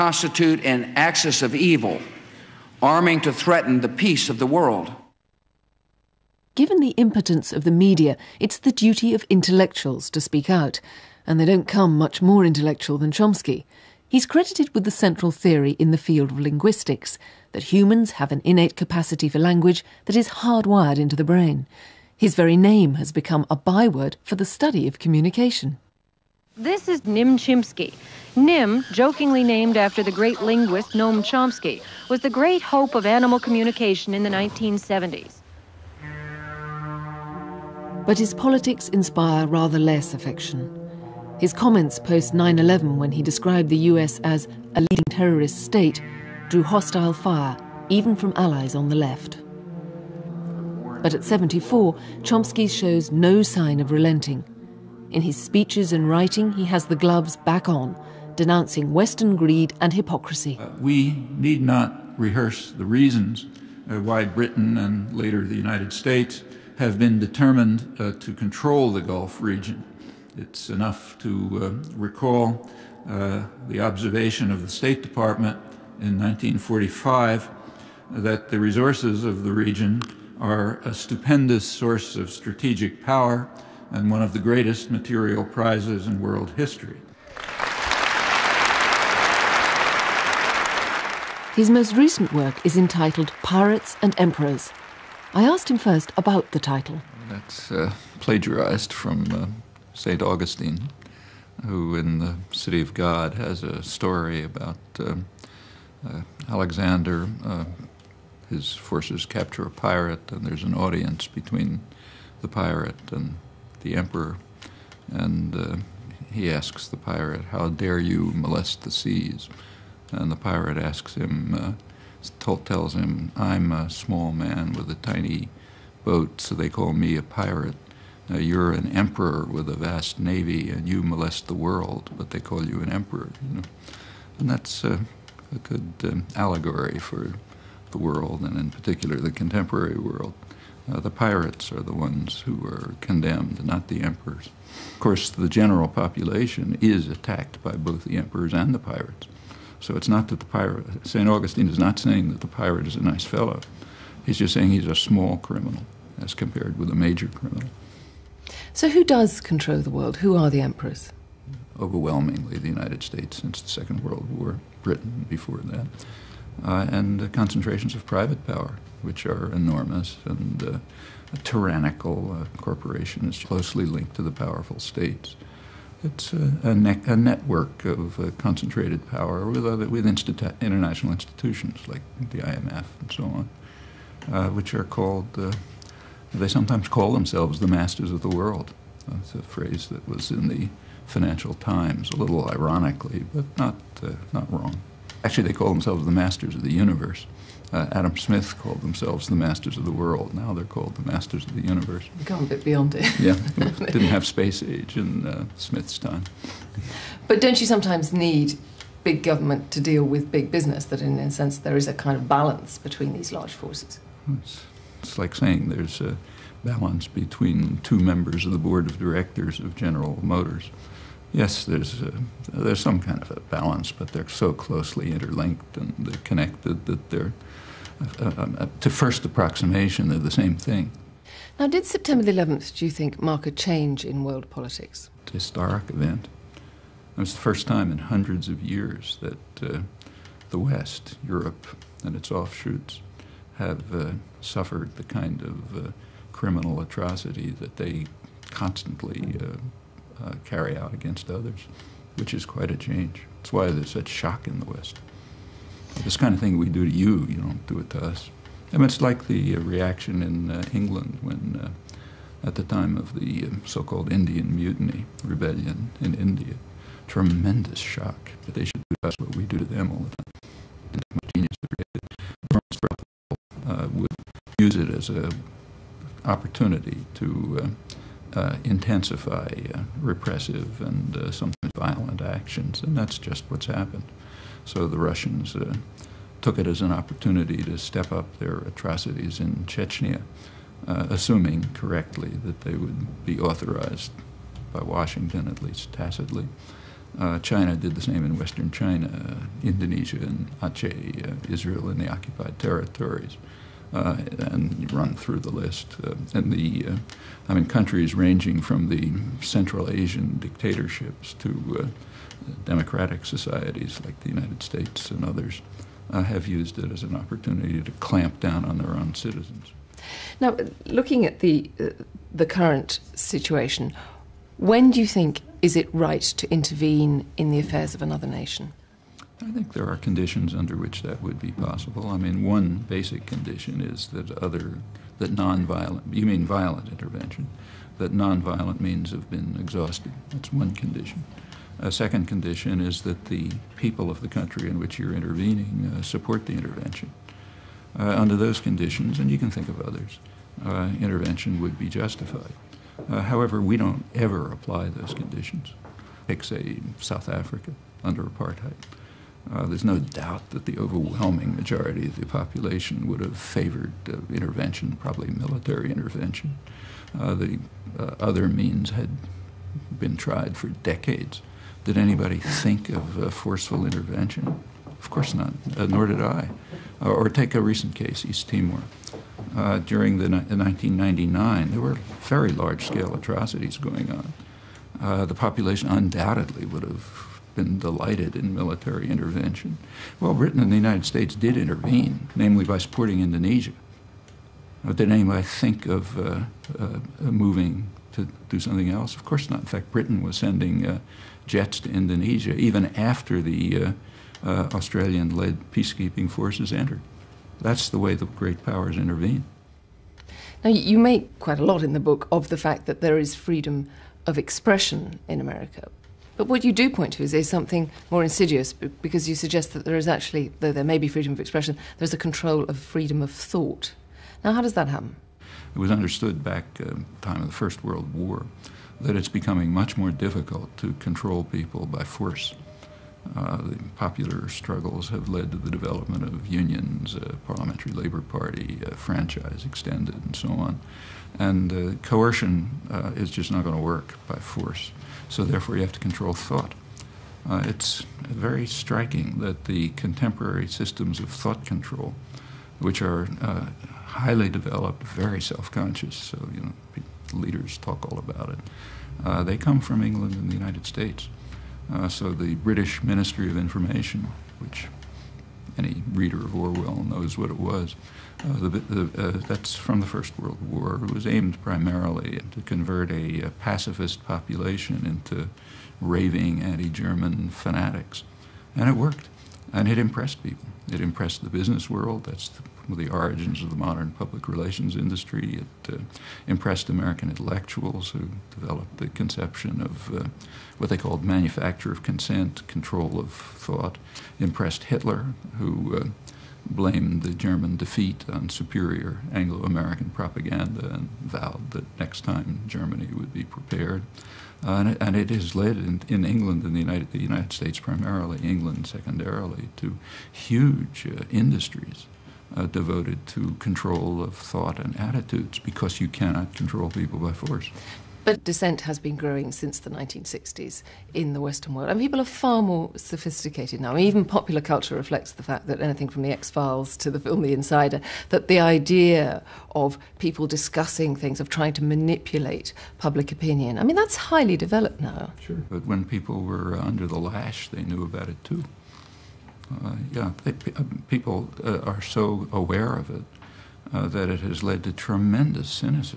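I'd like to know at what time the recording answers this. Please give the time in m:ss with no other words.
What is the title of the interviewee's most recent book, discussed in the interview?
1:33.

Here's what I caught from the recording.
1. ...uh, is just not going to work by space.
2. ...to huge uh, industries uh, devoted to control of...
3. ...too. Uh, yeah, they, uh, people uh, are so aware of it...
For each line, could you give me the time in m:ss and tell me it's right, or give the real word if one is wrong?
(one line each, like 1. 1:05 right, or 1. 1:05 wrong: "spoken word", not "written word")
1. 7:22 wrong: "force", not "space"
2. 8:29 right
3. 8:58 right.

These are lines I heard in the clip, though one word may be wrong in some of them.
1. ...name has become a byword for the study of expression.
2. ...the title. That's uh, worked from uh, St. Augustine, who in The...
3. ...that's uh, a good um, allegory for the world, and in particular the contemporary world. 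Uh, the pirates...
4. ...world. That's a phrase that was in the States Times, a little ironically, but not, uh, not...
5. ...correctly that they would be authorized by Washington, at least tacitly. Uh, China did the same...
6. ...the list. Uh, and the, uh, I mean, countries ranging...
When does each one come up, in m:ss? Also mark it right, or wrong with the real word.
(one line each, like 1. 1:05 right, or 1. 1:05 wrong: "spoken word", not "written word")
1. 0:22 wrong: "communication", not "expression"
2. 1:36 wrong: "plagiarized", not "worked"
3. 2:14 right
4. 3:08 wrong: "Financial", not "States"
5. 4:51 right
6. 5:05 right.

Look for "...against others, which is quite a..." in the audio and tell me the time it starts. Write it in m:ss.
4:10.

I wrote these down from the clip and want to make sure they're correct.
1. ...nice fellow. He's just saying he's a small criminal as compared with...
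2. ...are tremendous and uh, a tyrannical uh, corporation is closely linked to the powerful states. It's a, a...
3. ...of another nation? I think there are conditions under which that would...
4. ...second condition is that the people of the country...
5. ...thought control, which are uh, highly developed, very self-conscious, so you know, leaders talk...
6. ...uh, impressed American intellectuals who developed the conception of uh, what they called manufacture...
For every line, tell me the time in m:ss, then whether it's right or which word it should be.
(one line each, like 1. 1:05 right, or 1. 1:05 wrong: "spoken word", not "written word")
1. 2:33 right
2. 2:49 wrong: "enormous", not "tremendous"
3. 5:27 right
4. 5:41 right
5. 7:31 right
6. 8:05 right.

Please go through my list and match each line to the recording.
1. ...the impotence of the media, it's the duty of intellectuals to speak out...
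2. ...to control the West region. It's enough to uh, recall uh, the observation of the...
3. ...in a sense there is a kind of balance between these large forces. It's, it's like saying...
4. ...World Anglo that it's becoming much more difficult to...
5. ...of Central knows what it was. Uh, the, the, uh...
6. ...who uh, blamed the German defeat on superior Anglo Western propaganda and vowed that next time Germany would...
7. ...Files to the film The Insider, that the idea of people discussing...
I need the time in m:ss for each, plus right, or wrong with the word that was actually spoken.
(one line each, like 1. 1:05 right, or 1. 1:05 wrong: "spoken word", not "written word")
1. 0:06 right
2. 1:08 wrong: "Gulf", not "West"
3. 3:30 right
4. 7:07 wrong: "War", not "Anglo"
5. 7:46 wrong: "Orwell", not "Central"
6. 8:15 wrong: "American", not "Western"
7. 8:46 right.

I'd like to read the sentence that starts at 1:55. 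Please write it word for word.
And uh, he asks the pirate, How dare you molest the seas?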